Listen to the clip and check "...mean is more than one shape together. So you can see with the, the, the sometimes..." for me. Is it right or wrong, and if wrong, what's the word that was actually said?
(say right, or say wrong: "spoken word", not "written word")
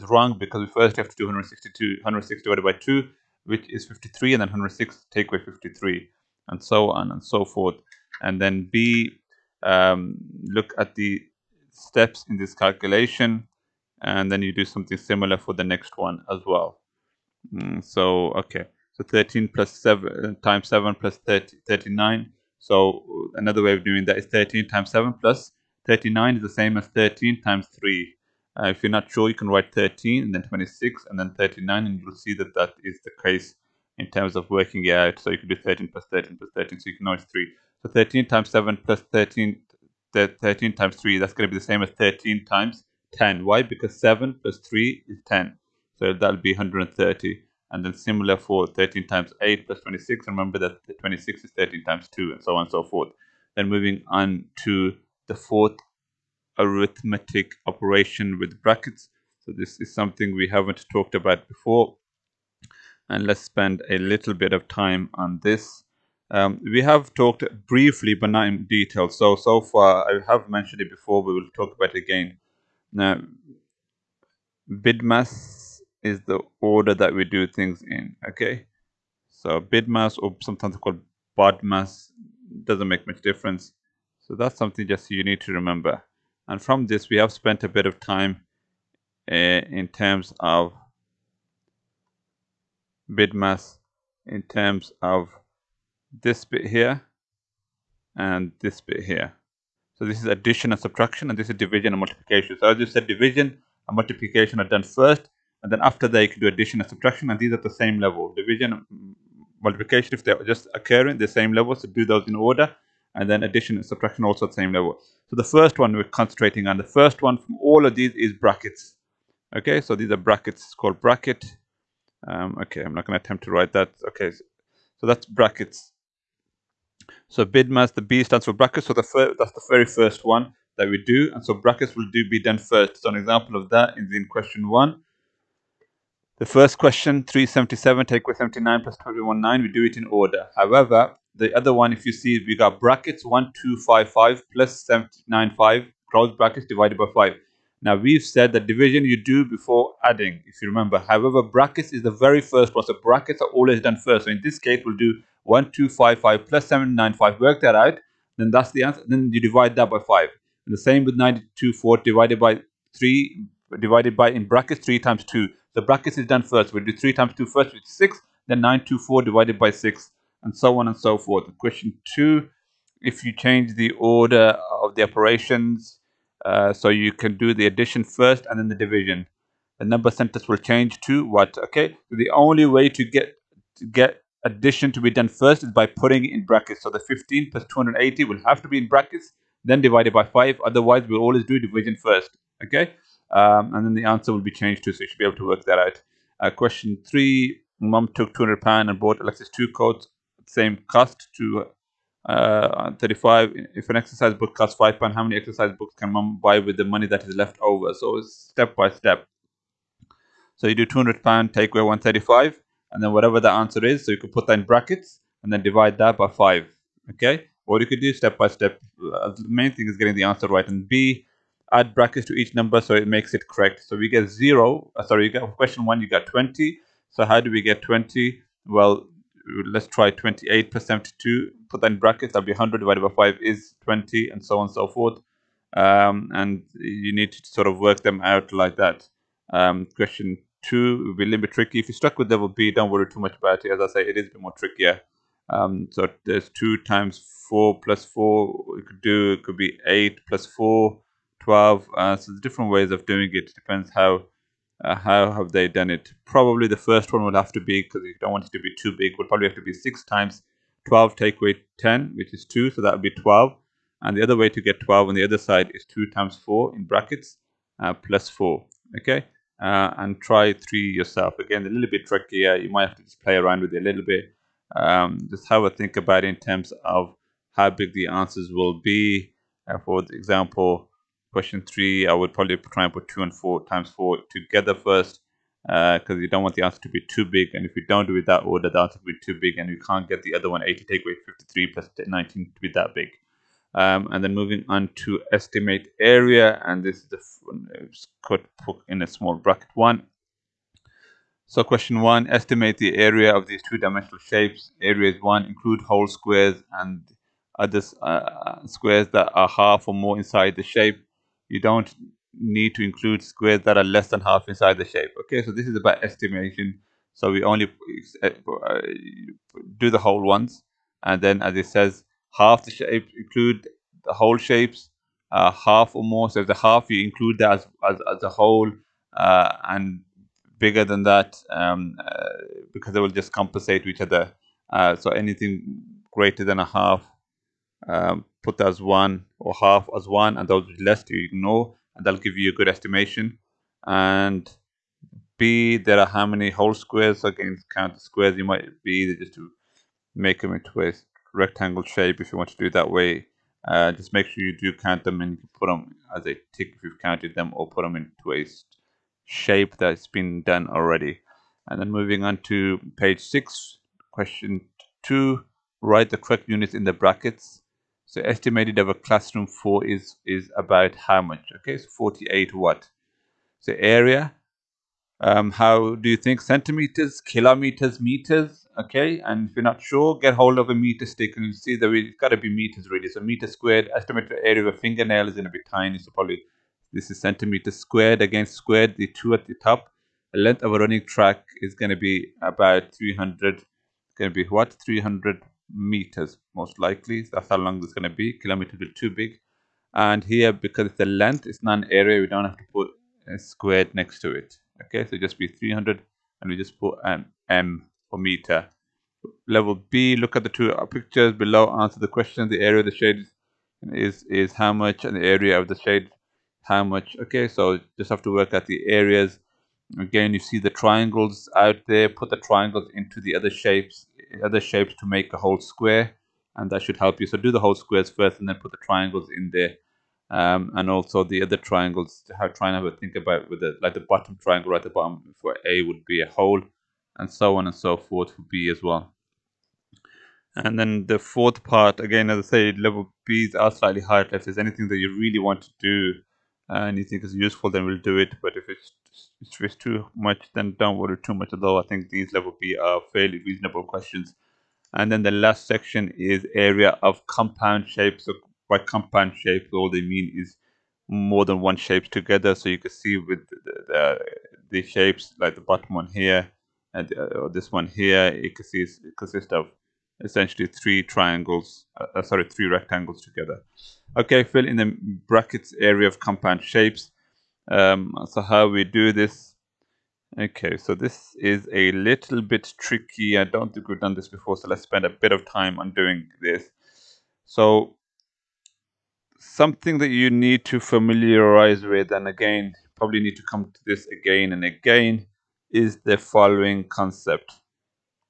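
wrong: "shapes", not "sometimes".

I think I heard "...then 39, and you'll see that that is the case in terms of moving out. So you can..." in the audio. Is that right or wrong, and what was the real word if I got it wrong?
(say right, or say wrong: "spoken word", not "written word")
wrong: "working", not "moving".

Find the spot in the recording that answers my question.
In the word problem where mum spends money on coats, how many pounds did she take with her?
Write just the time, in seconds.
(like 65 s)
198 s.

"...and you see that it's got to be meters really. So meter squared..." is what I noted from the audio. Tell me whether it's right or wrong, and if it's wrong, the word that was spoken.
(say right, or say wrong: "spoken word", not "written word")
right.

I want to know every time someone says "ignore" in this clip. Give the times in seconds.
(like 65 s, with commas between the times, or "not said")
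341 s.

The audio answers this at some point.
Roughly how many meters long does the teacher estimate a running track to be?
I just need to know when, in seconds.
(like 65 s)
394 s.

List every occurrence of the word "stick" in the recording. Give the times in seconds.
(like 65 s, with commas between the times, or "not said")
381 s.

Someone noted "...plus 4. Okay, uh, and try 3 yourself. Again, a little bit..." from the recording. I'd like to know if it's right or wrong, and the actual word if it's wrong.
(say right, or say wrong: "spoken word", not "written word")
right.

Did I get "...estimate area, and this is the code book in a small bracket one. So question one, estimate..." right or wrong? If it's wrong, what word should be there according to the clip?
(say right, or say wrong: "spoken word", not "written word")
right.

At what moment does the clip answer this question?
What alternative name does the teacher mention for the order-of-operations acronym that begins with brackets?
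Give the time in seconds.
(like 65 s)
81 s.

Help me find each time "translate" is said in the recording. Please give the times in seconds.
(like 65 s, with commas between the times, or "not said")
not said.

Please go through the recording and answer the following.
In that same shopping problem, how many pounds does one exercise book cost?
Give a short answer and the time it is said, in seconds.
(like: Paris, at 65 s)
5 pounds, at 204 s.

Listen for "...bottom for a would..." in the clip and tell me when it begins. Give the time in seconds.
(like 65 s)
434 s.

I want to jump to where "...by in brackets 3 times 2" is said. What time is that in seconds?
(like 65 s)
164 s.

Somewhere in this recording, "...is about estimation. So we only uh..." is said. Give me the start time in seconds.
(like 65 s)
315 s.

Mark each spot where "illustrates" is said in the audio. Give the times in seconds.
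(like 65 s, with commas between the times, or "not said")
not said.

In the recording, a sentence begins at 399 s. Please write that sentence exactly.
And here, because it's length, it's not an area.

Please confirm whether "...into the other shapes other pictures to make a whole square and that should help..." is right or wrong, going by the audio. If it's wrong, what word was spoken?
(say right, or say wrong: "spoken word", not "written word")
wrong: "shapes", not "pictures".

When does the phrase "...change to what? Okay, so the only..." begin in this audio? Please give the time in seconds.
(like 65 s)
180 s.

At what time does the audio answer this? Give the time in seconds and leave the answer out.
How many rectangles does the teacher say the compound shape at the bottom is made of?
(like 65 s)
472 s.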